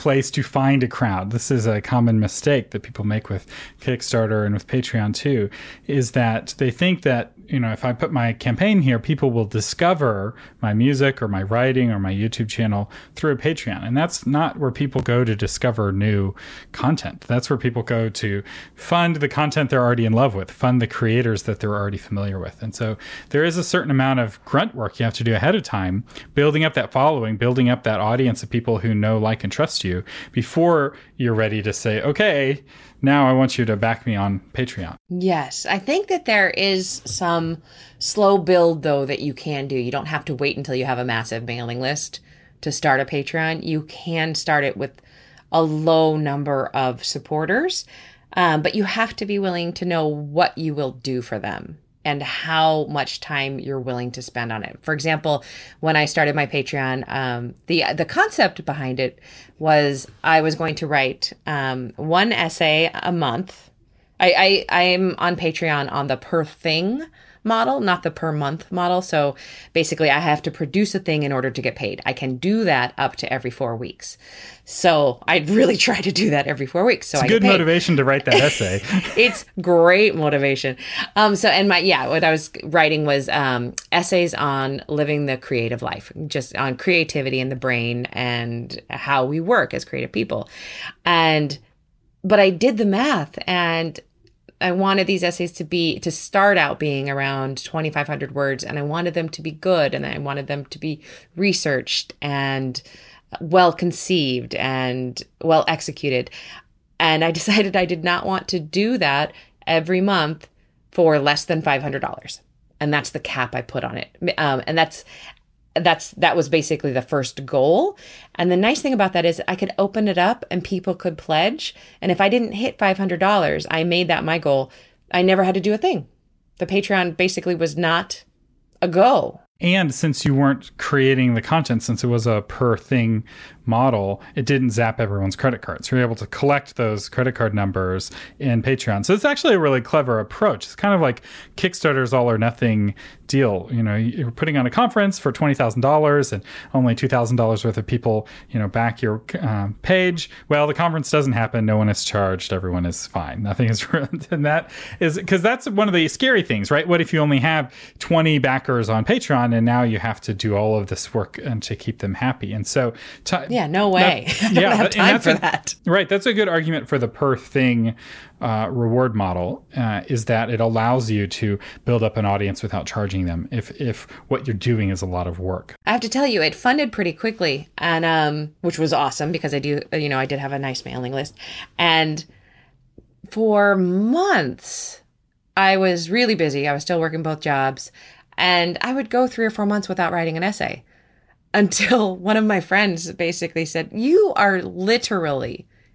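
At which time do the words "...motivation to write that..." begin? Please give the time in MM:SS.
01:17.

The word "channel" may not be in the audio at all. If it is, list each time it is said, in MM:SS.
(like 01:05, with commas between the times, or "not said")
00:12.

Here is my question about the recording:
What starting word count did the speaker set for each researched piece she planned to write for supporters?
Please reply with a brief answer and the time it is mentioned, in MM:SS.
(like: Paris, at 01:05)
2500, at 01:37.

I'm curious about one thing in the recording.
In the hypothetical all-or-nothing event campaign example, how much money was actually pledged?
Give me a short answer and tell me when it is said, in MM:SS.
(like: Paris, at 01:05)
$2,000, at 02:26.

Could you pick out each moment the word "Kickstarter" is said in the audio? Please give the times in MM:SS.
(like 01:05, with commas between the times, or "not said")
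00:03, 02:21.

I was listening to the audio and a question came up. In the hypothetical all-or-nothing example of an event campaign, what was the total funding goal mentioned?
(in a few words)
$20,000.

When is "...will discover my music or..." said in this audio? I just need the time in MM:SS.
00:09.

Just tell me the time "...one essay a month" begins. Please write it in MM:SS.
01:01.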